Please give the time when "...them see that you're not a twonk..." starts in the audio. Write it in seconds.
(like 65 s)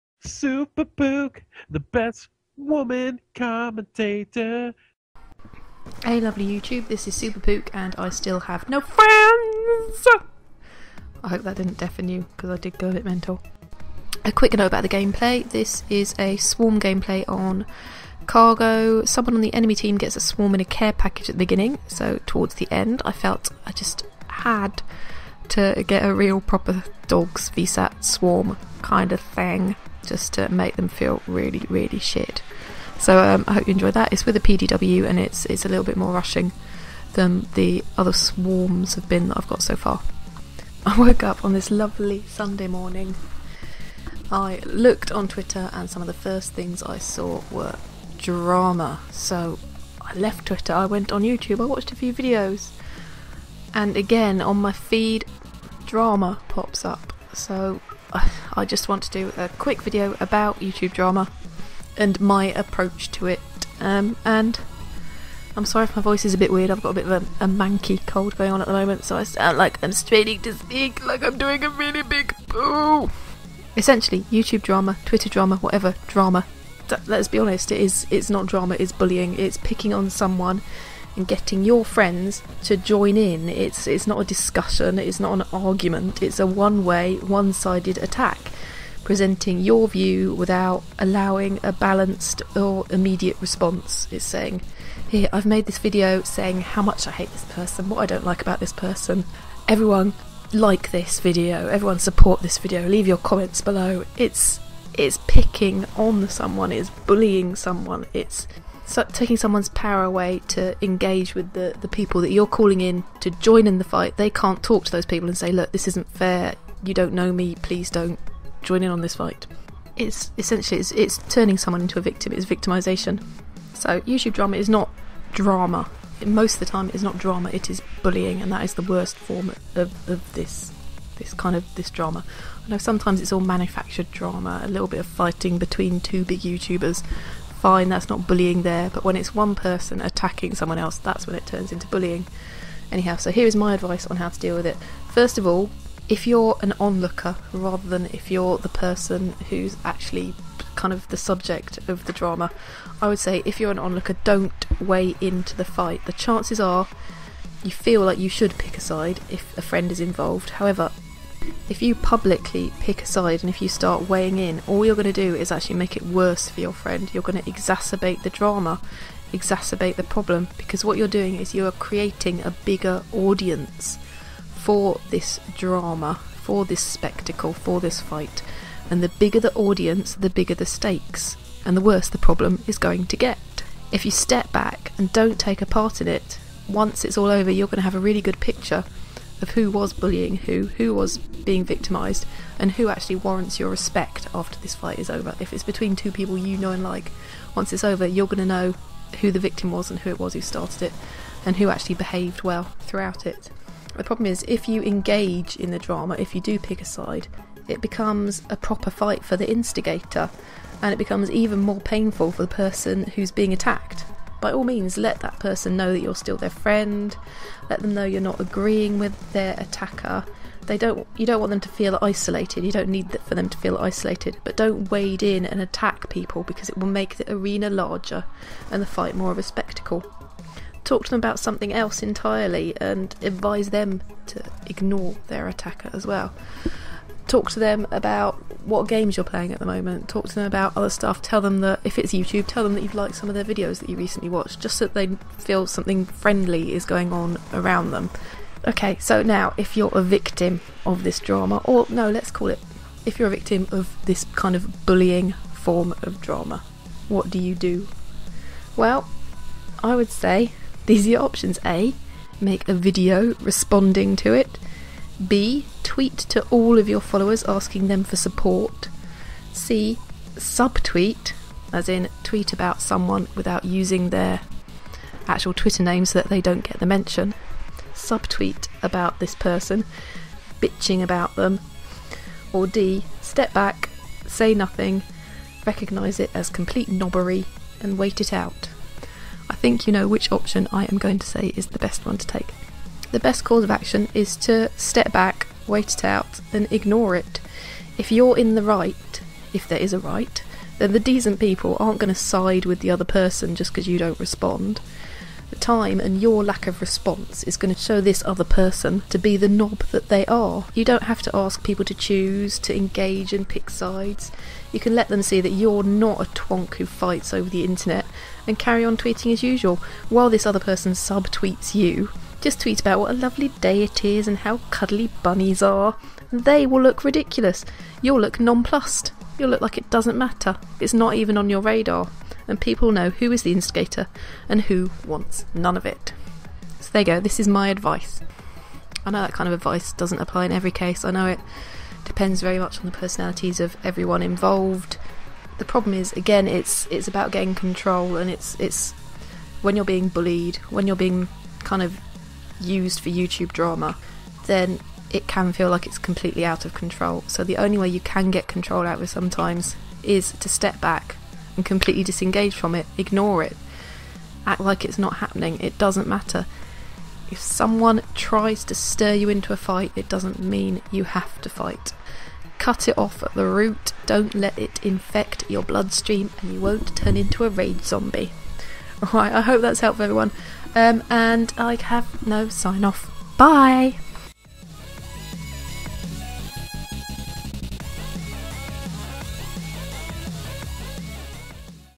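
315 s.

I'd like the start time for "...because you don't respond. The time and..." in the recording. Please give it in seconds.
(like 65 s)
303 s.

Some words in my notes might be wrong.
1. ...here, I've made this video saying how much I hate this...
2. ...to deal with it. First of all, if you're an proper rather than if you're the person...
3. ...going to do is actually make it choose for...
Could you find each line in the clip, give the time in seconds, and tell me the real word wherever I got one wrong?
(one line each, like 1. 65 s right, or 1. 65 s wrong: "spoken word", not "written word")
1. 95 s right
2. 144 s wrong: "onlooker", not "proper"
3. 164 s wrong: "worse", not "choose".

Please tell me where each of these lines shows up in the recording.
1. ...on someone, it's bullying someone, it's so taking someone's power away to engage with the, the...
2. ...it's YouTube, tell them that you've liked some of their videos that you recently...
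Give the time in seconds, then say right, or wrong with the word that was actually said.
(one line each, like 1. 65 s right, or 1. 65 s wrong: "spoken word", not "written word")
1. 105 s right
2. 241 s right.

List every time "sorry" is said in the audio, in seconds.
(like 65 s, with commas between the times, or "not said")
65 s.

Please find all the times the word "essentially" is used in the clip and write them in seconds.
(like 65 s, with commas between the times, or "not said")
73 s, 120 s.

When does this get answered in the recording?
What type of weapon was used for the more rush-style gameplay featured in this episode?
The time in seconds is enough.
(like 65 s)
34 s.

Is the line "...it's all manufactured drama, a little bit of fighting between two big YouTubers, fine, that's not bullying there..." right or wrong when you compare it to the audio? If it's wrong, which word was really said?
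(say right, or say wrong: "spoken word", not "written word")
right.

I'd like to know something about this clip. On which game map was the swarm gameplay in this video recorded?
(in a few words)
Cargo.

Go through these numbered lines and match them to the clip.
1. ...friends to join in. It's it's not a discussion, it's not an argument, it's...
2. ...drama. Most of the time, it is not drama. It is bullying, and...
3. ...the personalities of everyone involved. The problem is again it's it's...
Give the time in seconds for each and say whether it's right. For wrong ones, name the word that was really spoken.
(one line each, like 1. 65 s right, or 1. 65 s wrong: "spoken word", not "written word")
1. 81 s right
2. 125 s right
3. 342 s right.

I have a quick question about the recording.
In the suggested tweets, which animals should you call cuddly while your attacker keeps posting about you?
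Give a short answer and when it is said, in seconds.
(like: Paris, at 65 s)
bunnies, at 325 s.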